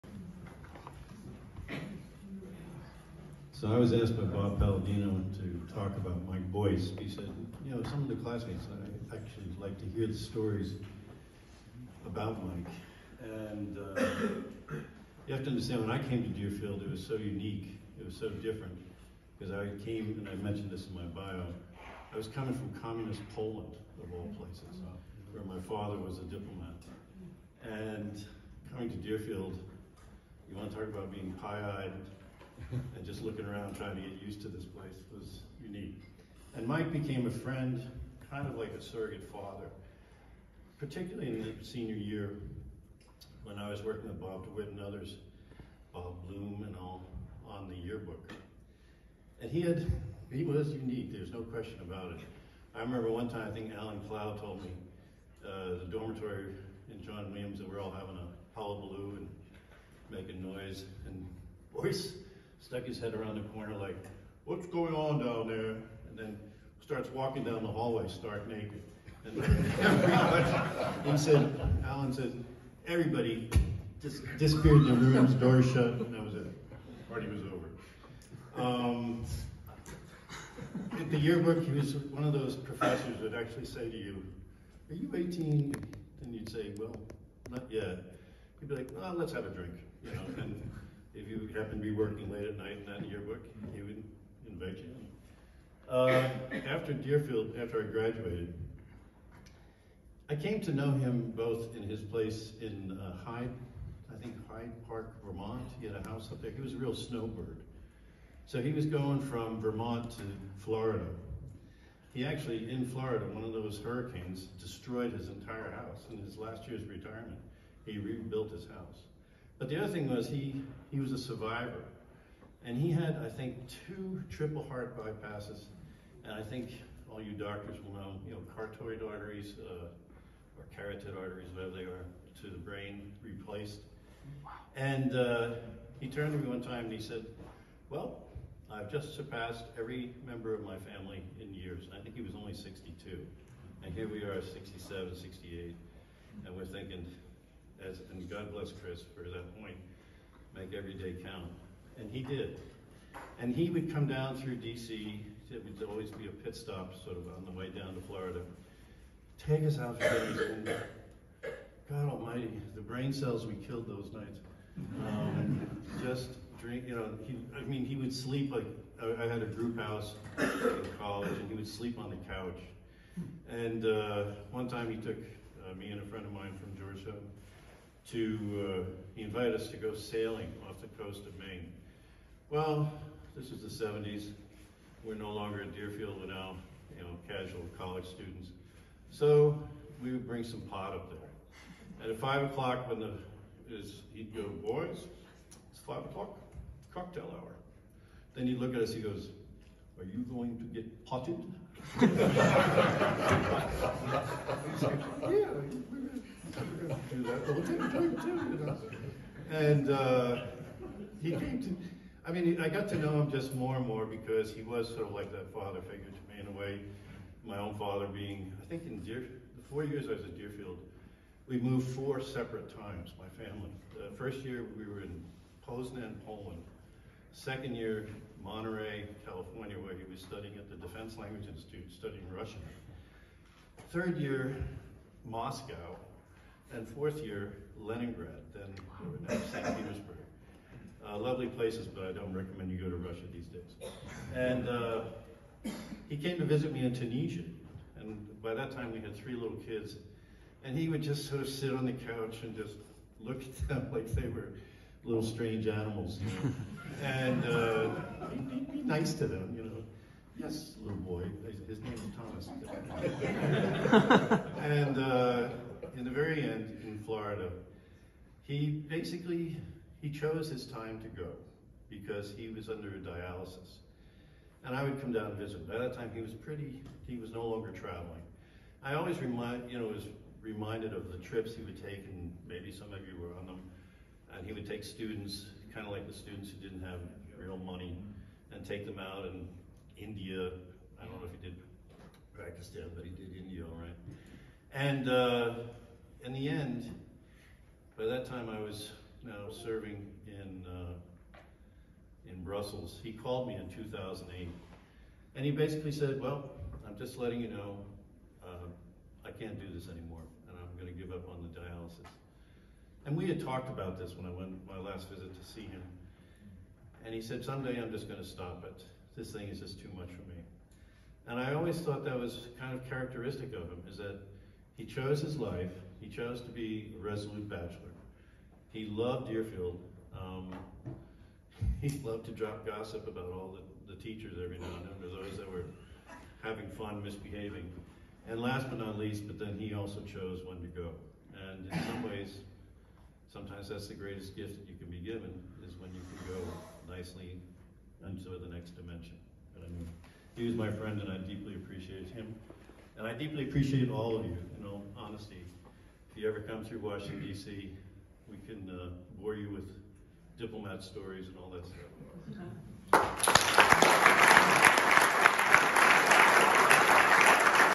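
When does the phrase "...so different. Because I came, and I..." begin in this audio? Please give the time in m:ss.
0:18.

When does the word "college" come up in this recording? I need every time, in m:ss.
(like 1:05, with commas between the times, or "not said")
2:50, 3:07.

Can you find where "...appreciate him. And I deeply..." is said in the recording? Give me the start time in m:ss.
5:51.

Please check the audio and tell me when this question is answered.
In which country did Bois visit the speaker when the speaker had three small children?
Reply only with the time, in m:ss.
4:06.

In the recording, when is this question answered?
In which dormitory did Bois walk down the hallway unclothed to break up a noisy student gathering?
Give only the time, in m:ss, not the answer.
0:57.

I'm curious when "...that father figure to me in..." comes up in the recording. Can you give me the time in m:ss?
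3:35.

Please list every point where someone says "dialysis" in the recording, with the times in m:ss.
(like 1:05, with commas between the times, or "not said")
4:32, 5:11.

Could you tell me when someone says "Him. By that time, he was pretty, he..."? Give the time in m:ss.
4:35.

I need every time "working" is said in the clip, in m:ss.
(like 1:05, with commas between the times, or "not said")
0:43, 1:31.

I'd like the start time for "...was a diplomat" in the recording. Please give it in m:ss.
0:25.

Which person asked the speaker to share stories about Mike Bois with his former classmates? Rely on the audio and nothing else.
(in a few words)
Bob Palladino.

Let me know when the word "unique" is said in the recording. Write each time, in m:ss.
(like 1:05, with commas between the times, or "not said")
0:17, 0:35, 0:50.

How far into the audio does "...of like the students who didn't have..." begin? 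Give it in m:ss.
4:45.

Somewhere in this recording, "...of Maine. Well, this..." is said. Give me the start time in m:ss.
3:01.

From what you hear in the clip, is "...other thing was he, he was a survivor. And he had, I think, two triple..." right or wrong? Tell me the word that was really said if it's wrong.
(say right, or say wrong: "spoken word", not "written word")
right.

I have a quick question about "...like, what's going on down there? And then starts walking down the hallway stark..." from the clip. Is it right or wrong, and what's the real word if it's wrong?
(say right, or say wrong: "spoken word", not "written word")
right.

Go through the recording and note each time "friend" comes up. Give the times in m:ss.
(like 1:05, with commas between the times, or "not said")
0:37, 2:56, 5:50.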